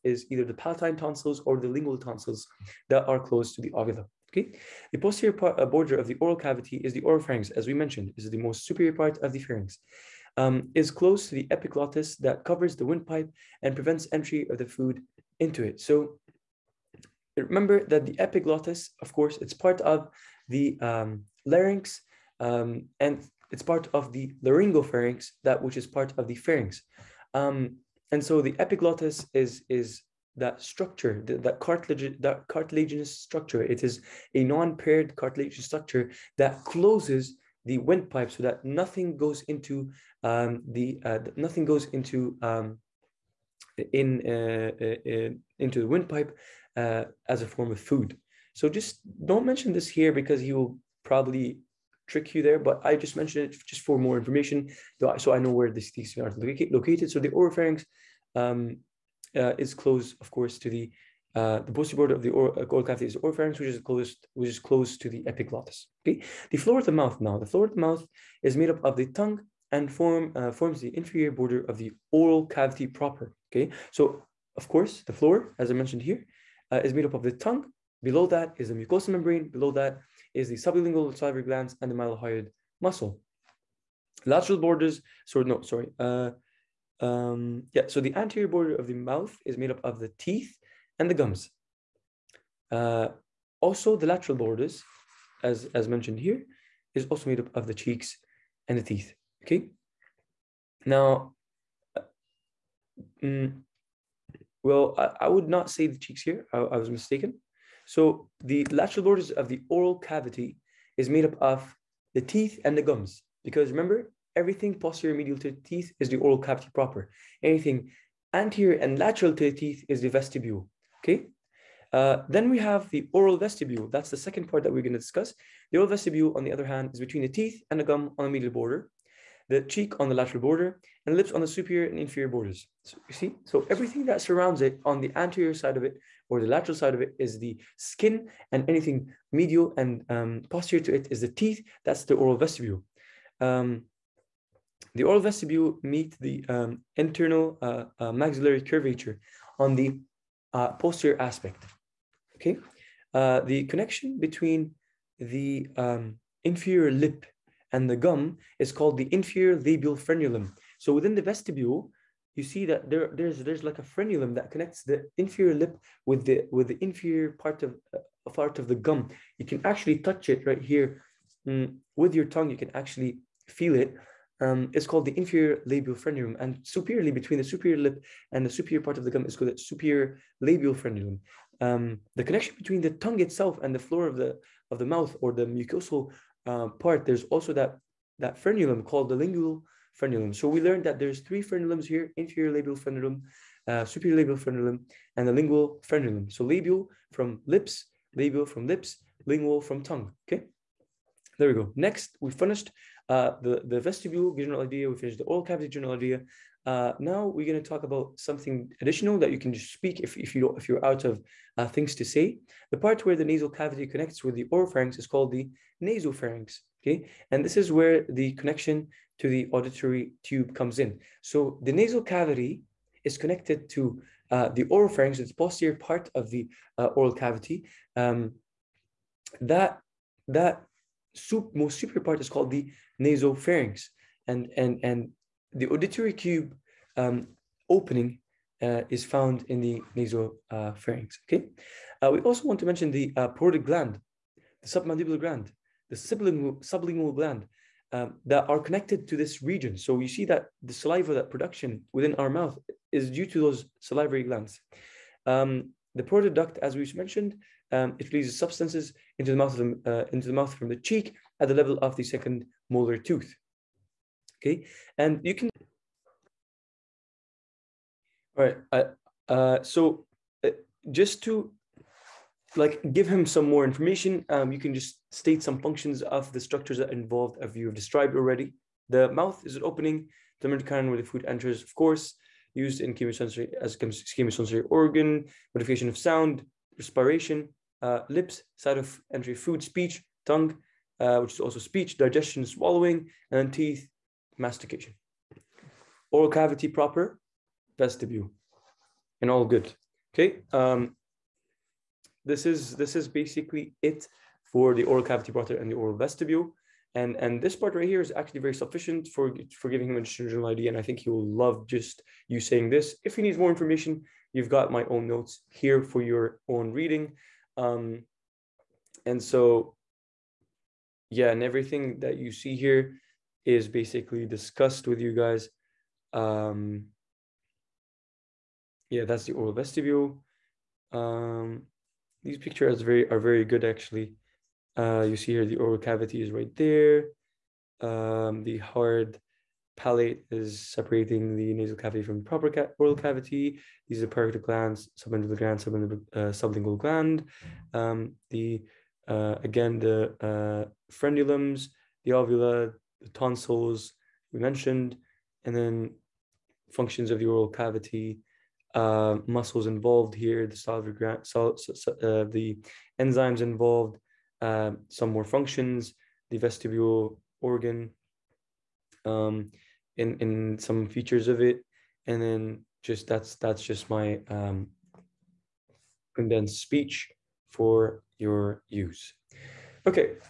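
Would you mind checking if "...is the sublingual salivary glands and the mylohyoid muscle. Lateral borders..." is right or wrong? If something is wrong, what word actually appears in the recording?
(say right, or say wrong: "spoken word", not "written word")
right.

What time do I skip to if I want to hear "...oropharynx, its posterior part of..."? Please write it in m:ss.
3:44.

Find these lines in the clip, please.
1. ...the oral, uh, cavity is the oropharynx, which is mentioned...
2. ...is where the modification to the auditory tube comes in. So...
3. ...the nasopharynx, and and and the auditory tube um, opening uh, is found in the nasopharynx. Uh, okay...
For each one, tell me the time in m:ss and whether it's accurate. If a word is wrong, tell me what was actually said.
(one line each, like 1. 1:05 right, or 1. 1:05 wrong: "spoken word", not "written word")
1. 1:02 wrong: "closed", not "mentioned"
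2. 3:37 wrong: "connection", not "modification"
3. 3:52 right.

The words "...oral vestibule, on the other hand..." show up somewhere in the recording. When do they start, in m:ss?
2:05.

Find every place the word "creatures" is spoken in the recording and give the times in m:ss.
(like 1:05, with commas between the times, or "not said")
not said.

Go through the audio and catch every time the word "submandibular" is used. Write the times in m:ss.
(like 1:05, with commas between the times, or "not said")
4:04, 5:45.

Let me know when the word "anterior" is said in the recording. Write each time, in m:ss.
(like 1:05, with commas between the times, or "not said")
1:28, 1:58, 2:15.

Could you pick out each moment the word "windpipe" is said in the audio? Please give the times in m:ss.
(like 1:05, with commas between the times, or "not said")
0:12, 0:37, 0:45.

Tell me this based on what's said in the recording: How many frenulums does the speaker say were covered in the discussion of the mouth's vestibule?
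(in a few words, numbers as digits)
3.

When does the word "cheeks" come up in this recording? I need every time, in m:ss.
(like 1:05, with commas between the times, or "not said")
1:37, 1:45, 2:09, 4:20.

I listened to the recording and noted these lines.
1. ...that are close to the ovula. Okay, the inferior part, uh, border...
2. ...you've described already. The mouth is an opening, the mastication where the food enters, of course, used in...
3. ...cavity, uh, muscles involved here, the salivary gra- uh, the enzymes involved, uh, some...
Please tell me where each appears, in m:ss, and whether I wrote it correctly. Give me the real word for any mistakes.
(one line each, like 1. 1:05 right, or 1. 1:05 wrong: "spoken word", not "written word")
1. 0:02 wrong: "posterior", not "inferior"
2. 4:37 wrong: "mitochondrion", not "mastication"
3. 5:57 right.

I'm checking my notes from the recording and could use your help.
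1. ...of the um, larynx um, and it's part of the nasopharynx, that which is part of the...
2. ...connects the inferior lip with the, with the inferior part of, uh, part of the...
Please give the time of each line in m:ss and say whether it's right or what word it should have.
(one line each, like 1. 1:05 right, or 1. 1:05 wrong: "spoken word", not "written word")
1. 0:19 wrong: "laryngopharynx", not "nasopharynx"
2. 2:44 right.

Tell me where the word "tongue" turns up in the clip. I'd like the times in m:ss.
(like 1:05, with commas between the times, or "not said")
1:09, 1:17, 2:52, 3:02, 3:19, 4:50.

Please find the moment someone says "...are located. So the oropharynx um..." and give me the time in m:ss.
0:56.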